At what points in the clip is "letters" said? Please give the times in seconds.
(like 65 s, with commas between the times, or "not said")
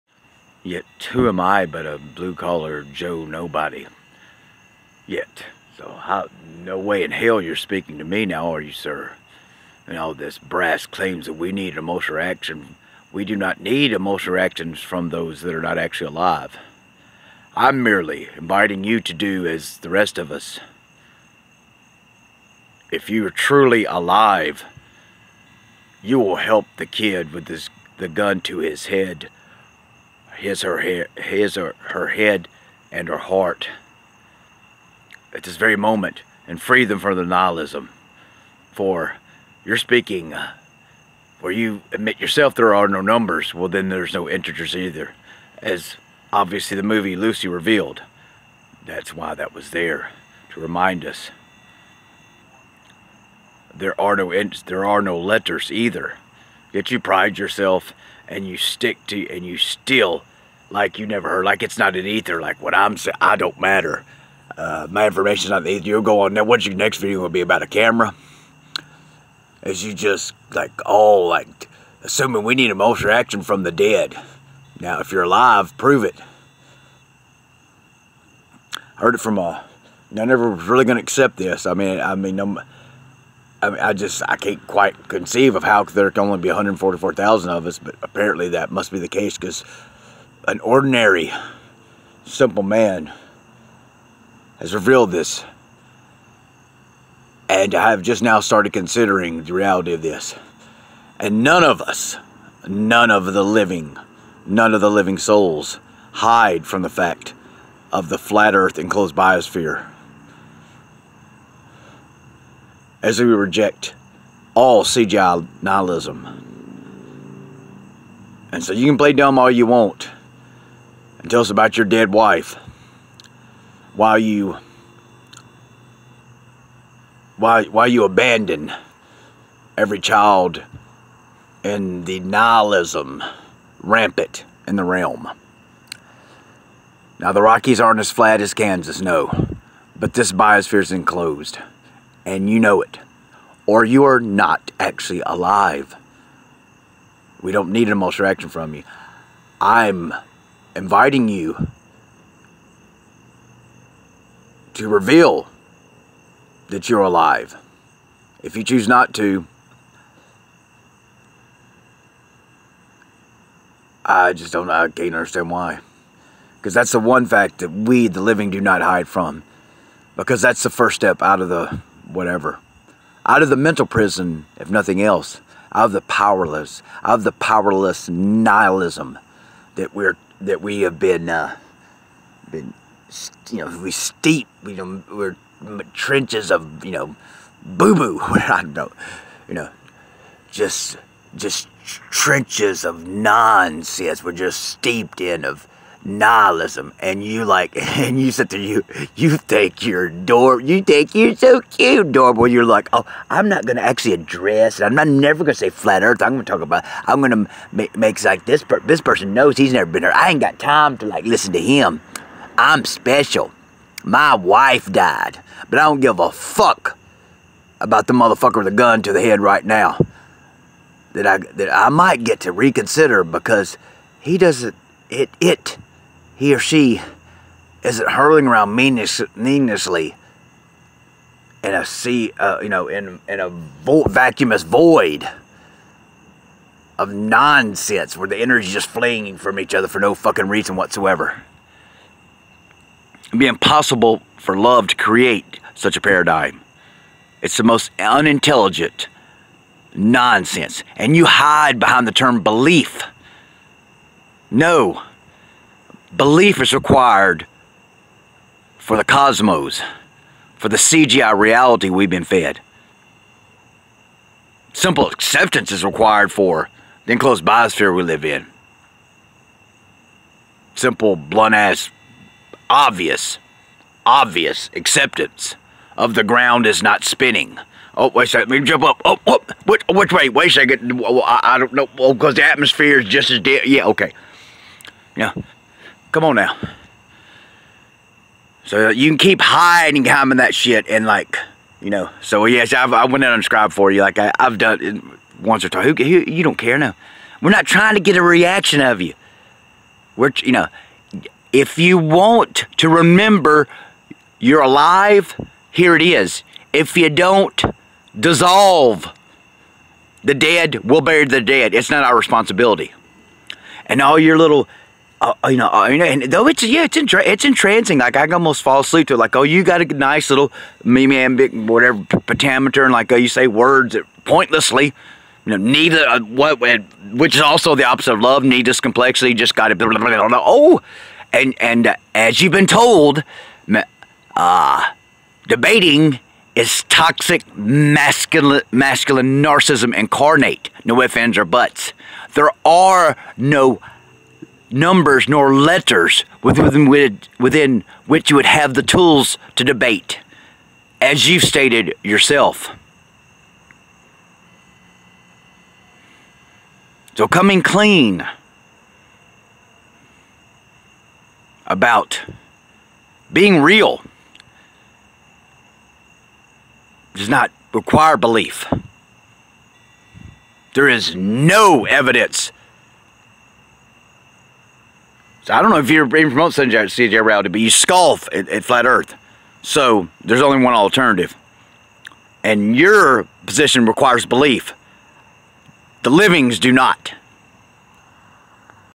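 55 s, 345 s.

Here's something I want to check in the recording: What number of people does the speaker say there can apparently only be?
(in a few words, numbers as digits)
144,000.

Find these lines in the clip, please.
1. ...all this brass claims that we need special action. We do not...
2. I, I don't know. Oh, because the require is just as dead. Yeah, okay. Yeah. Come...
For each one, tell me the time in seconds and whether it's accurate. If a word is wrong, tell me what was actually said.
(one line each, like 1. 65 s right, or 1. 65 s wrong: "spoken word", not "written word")
1. 9 s wrong: "emotional", not "special"
2. 281 s wrong: "atmosphere", not "require".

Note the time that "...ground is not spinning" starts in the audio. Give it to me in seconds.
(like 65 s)
276 s.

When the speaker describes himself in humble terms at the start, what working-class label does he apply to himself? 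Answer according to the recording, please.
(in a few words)
blue-collar Joe.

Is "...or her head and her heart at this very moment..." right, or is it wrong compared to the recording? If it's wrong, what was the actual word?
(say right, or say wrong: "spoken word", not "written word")
right.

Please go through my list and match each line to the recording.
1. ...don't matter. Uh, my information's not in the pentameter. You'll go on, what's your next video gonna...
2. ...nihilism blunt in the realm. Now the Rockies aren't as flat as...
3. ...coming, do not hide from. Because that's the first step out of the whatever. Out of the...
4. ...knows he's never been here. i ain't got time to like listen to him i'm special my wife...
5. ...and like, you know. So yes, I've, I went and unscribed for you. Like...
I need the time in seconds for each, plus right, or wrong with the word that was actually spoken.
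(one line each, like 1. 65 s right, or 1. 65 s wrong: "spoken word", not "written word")
1. 63 s wrong: "ether", not "pentameter"
2. 132 s wrong: "rampant", not "blunt"
3. 168 s wrong: "living", not "coming"
4. 209 s right
5. 290 s right.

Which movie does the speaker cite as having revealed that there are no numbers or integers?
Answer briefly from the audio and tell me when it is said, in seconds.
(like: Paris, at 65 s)
Lucy, at 47 s.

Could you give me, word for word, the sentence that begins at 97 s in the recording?
And I have just now started considering the reality of this.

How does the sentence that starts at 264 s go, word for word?
Simple acceptance is required for the enclosed biosphere we live in.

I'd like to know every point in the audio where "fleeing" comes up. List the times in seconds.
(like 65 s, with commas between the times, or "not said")
238 s.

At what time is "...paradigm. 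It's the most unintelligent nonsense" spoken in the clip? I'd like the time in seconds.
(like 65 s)
246 s.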